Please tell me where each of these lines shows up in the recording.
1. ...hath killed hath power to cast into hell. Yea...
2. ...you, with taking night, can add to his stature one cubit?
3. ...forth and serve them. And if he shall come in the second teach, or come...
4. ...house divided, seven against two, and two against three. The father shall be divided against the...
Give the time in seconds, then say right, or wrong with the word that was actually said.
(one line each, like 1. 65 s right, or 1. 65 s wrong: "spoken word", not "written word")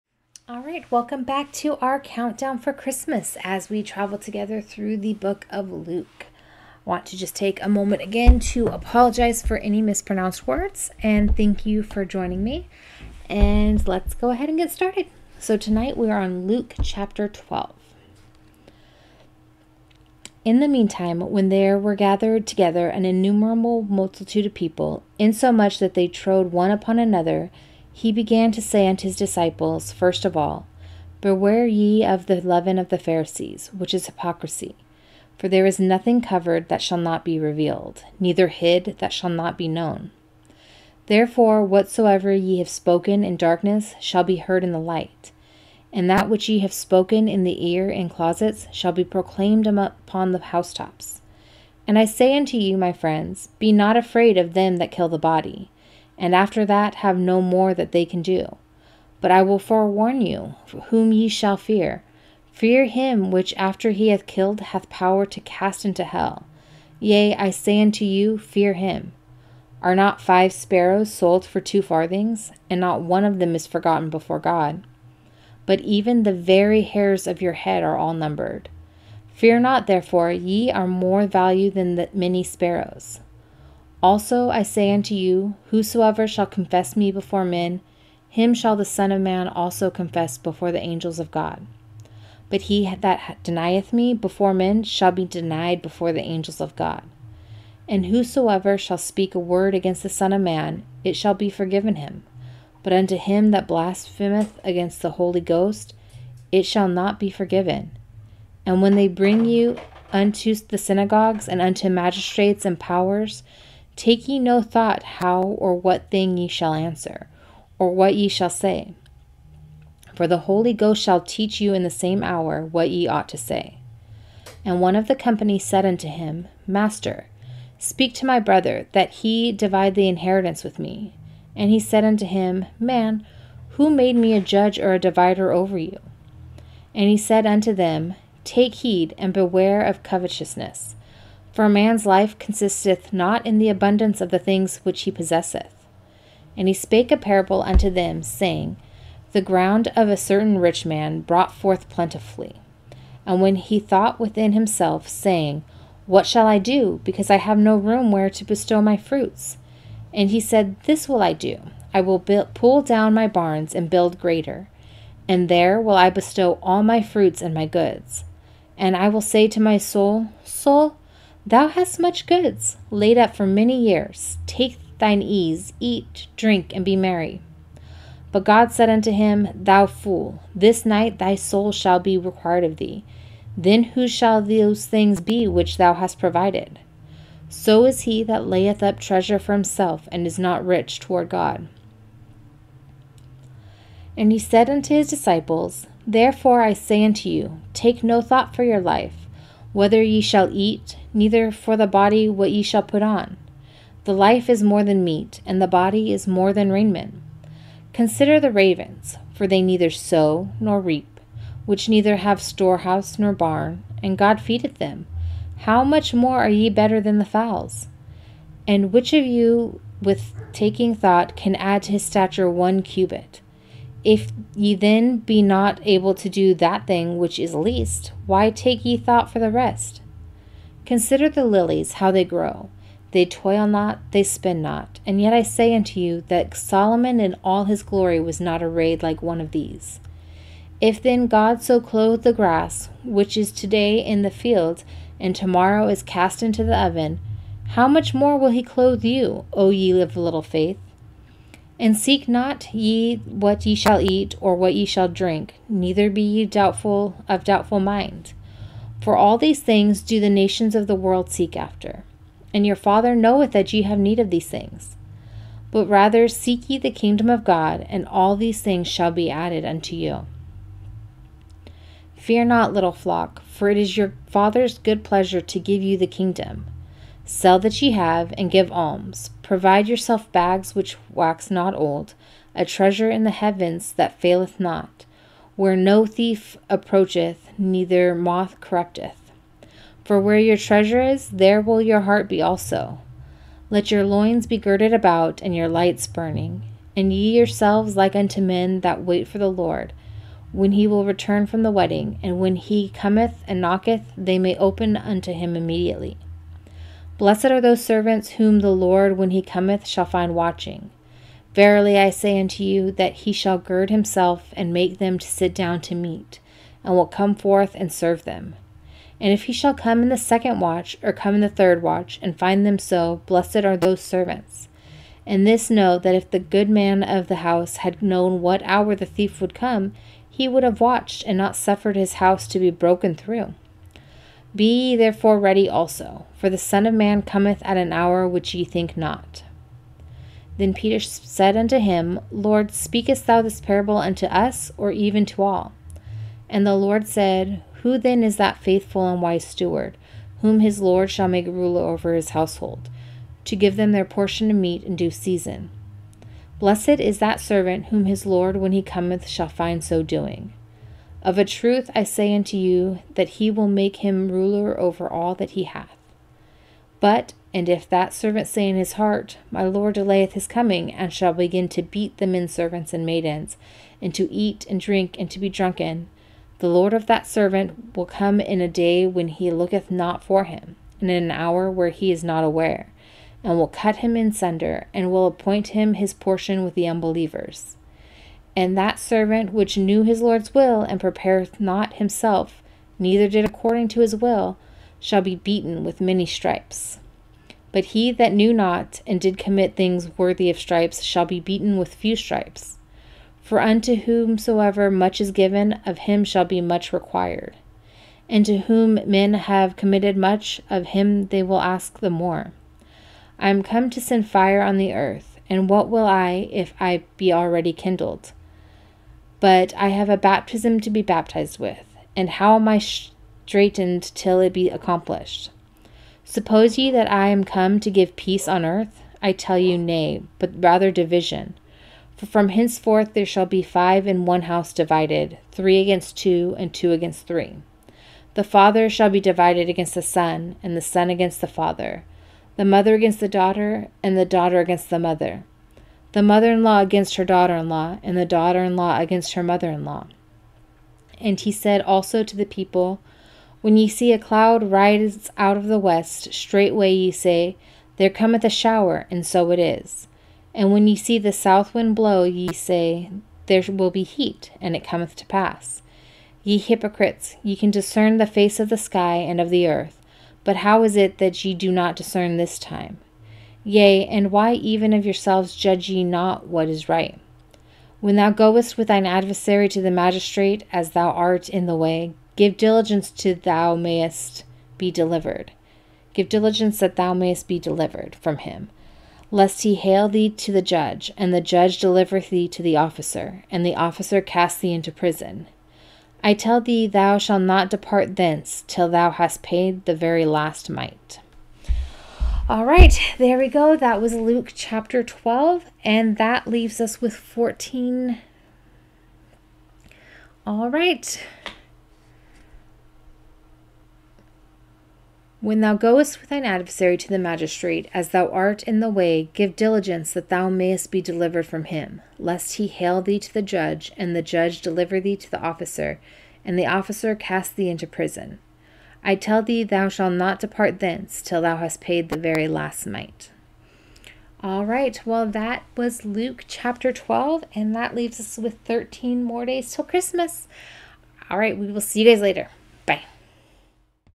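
1. 64 s right
2. 219 s wrong: "thought", not "night"
3. 317 s wrong: "watch", not "teach"
4. 434 s wrong: "three", not "seven".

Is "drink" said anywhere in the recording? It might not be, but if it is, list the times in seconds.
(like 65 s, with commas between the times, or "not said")
176 s, 255 s, 374 s.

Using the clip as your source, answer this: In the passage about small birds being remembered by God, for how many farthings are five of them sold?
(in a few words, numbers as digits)
2.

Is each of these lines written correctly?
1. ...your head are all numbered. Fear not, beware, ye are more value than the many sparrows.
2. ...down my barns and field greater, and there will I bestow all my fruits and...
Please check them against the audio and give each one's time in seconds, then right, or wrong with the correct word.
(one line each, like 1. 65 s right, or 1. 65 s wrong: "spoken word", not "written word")
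1. 77 s wrong: "therefore", not "beware"
2. 162 s wrong: "build", not "field".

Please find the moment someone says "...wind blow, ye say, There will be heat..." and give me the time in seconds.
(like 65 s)
461 s.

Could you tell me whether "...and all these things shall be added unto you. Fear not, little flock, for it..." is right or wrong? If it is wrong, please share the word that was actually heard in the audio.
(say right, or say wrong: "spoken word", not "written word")
right.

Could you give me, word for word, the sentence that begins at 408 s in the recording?
And to whom men have committed much, of him they will ask the more.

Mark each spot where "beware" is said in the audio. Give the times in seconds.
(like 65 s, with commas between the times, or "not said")
31 s, 139 s.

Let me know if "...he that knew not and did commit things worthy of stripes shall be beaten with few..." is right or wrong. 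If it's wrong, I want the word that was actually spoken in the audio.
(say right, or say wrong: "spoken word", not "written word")
right.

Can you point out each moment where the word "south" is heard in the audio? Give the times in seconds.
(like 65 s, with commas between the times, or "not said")
461 s.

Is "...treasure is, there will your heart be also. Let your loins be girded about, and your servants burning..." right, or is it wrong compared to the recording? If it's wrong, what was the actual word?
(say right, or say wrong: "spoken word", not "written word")
wrong: "lights", not "servants".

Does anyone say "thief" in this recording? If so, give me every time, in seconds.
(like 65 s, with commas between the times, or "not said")
286 s, 329 s.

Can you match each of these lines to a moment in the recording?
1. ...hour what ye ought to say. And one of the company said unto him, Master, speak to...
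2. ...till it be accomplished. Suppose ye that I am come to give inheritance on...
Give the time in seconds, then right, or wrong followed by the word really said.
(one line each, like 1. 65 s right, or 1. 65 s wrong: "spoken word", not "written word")
1. 122 s right
2. 424 s wrong: "peace", not "inheritance".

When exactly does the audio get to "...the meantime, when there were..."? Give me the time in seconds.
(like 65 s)
20 s.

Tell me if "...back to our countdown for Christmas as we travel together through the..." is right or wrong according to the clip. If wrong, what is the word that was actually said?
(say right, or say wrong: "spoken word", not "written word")
right.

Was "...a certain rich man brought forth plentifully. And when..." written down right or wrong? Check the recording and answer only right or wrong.
right.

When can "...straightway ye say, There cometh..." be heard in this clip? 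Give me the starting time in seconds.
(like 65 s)
456 s.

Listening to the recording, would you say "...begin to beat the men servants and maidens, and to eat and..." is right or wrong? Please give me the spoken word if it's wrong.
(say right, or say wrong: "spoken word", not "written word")
right.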